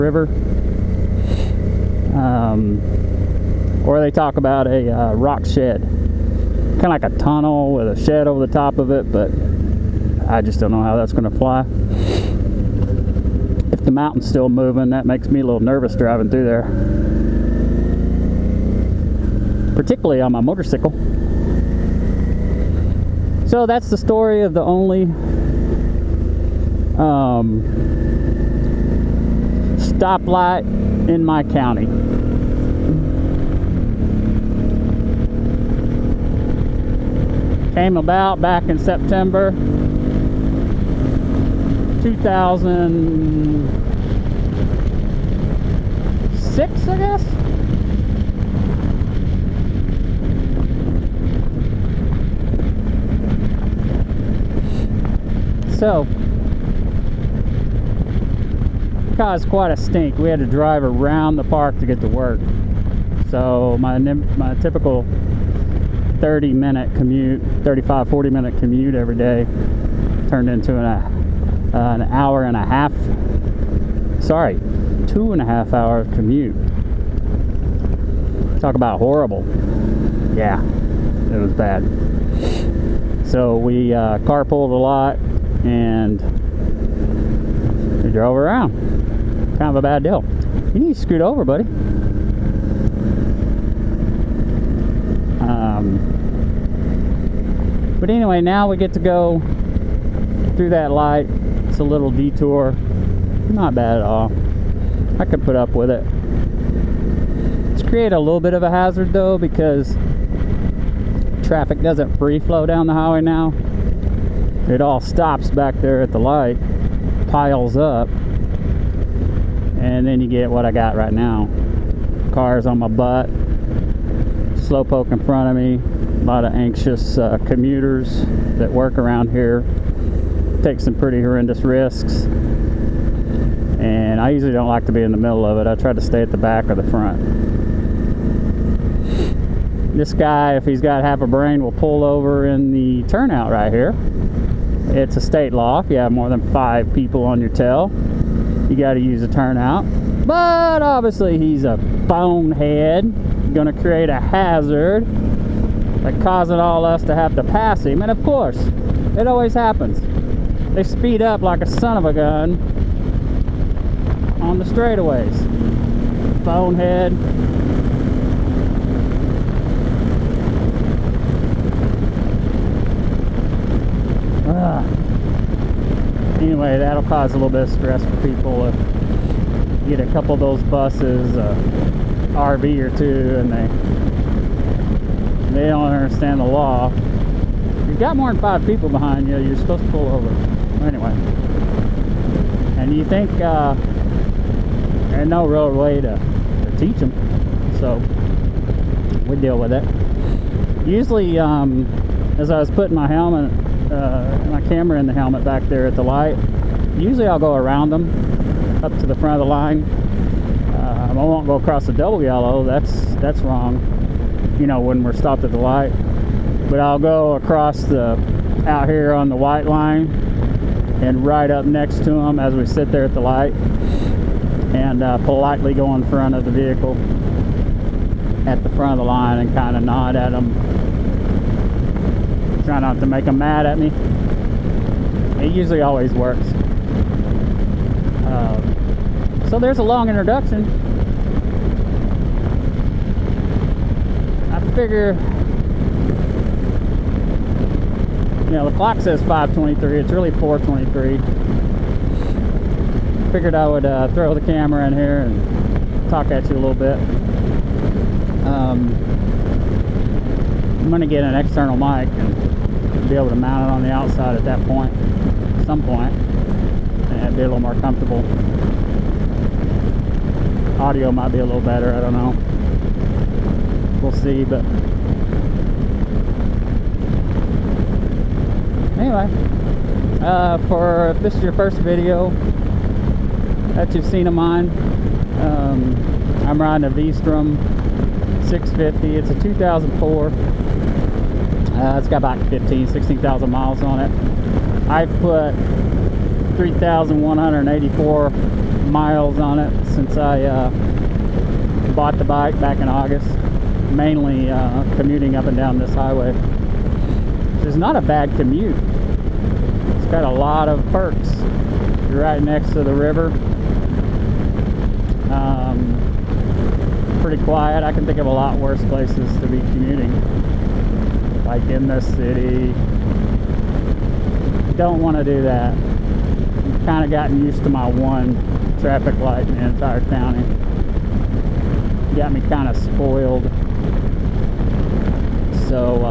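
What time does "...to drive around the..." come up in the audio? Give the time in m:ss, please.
1:00.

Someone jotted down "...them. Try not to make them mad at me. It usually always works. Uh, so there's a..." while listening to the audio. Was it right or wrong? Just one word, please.
right.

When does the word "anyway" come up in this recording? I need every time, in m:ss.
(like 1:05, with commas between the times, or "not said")
1:38, 2:56, 3:10, 4:38.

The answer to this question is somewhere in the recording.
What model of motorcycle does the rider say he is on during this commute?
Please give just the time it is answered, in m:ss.
4:46.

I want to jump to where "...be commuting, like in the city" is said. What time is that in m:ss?
5:19.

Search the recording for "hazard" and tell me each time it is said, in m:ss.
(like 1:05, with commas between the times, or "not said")
1:48, 2:34.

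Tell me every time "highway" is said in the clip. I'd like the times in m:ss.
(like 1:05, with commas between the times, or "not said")
1:52, 5:05.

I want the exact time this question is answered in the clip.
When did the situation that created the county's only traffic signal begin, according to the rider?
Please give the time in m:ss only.
0:38.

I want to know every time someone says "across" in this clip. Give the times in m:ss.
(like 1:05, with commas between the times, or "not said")
3:31, 3:37.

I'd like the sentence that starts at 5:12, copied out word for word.
You're right next to the river.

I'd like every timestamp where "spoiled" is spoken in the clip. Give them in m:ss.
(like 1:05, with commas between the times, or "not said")
5:32.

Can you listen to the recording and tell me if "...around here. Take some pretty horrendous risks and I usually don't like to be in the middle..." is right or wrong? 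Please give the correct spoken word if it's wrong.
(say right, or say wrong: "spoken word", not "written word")
right.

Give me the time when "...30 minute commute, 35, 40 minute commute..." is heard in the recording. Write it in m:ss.
1:06.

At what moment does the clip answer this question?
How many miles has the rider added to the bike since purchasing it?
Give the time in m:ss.
4:56.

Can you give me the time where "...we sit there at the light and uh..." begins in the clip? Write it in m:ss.
3:42.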